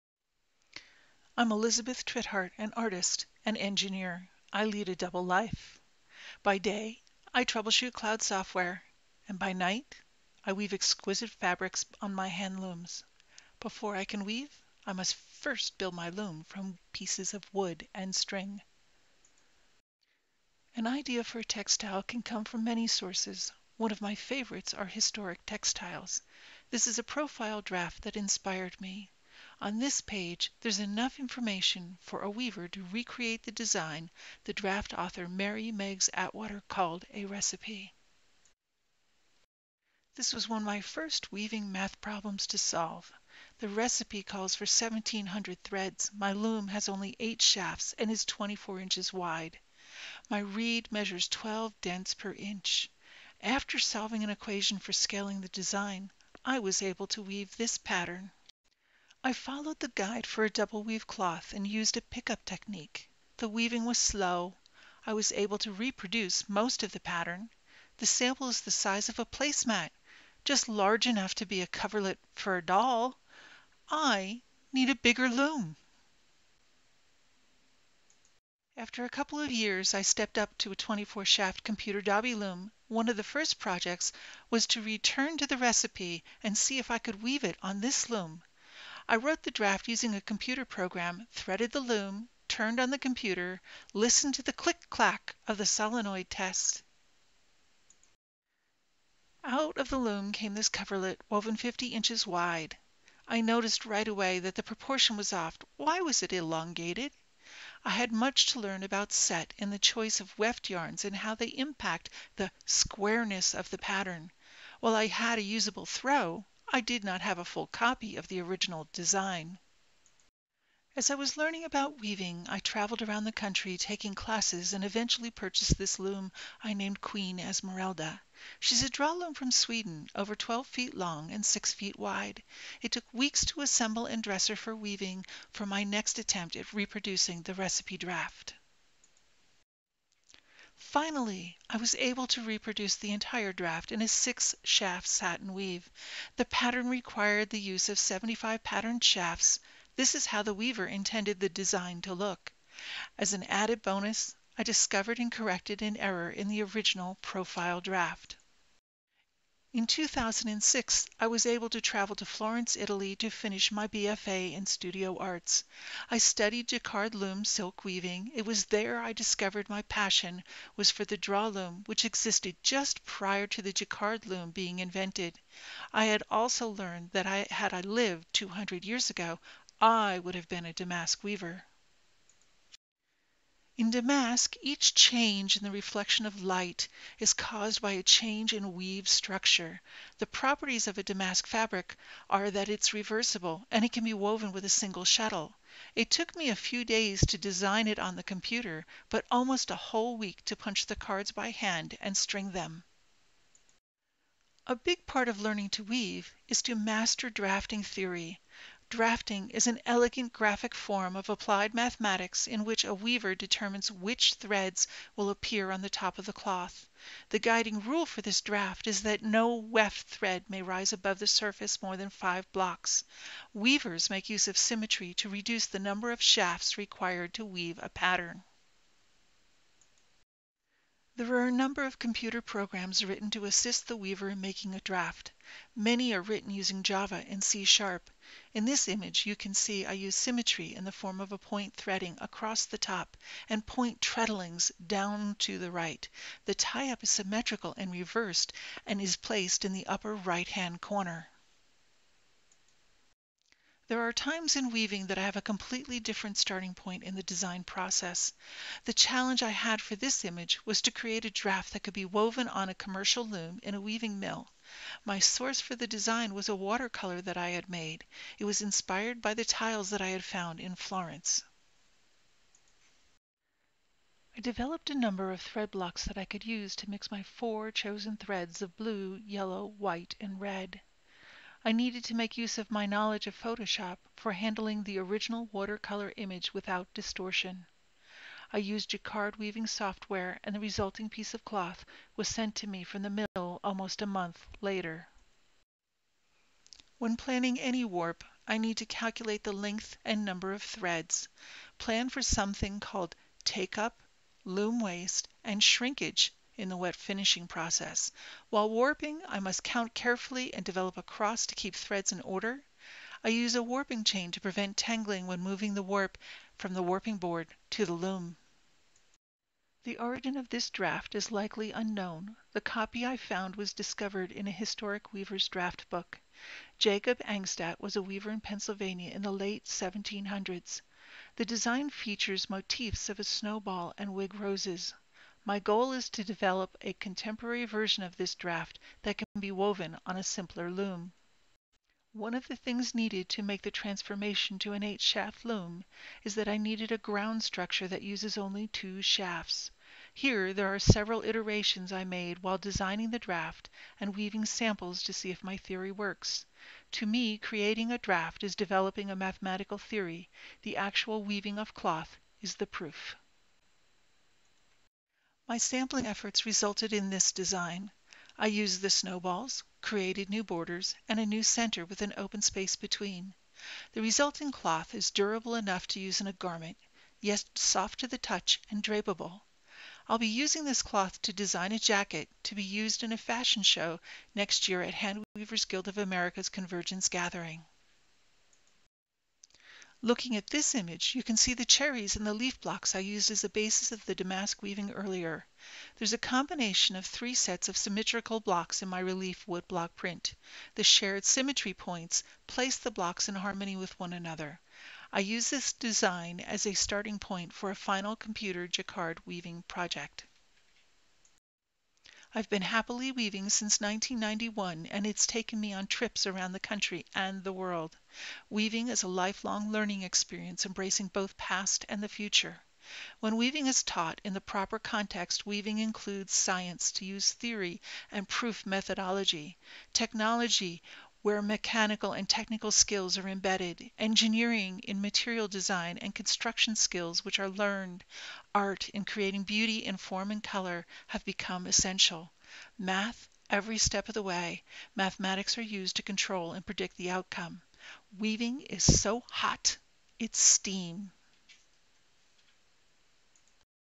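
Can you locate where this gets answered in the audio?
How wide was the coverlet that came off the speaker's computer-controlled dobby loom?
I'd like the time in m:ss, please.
1:41.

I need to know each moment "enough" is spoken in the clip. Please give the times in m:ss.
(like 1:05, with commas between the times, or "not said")
0:30, 1:11, 6:15.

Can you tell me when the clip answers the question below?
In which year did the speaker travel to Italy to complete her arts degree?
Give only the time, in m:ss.
2:39.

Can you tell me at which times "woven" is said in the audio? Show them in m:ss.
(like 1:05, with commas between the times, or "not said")
1:41, 3:14, 4:22, 5:39.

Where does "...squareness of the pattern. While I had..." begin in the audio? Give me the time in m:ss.
1:52.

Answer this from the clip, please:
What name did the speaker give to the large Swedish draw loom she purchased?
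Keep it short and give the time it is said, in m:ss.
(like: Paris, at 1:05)
Queen Esmeralda, at 2:07.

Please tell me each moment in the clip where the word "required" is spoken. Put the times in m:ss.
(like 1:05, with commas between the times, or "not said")
2:26, 3:46.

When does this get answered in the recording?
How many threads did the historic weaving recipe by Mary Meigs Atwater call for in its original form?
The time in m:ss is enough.
0:44.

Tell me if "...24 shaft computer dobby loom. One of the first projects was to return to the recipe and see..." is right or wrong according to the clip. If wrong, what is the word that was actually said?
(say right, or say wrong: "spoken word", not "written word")
right.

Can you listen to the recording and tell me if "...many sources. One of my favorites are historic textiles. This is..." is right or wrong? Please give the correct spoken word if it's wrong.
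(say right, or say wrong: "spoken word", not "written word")
right.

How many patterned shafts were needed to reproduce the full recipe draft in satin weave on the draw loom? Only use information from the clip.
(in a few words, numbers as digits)
75.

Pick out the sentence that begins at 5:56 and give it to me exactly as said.
To me, creating a draft is developing a mathematical theory.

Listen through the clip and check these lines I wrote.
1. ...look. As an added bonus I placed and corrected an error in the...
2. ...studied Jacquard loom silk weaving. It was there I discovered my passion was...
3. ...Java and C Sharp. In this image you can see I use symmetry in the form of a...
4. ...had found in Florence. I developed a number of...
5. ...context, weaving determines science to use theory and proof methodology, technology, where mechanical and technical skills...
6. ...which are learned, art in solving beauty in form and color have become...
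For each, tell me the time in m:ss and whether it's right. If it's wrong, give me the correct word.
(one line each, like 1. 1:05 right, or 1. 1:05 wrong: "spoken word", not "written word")
1. 2:32 wrong: "discovered", not "placed"
2. 2:46 right
3. 3:56 right
4. 4:30 right
5. 7:04 wrong: "includes", not "determines"
6. 7:17 wrong: "creating", not "solving".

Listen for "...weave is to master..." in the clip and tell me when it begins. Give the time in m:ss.
3:25.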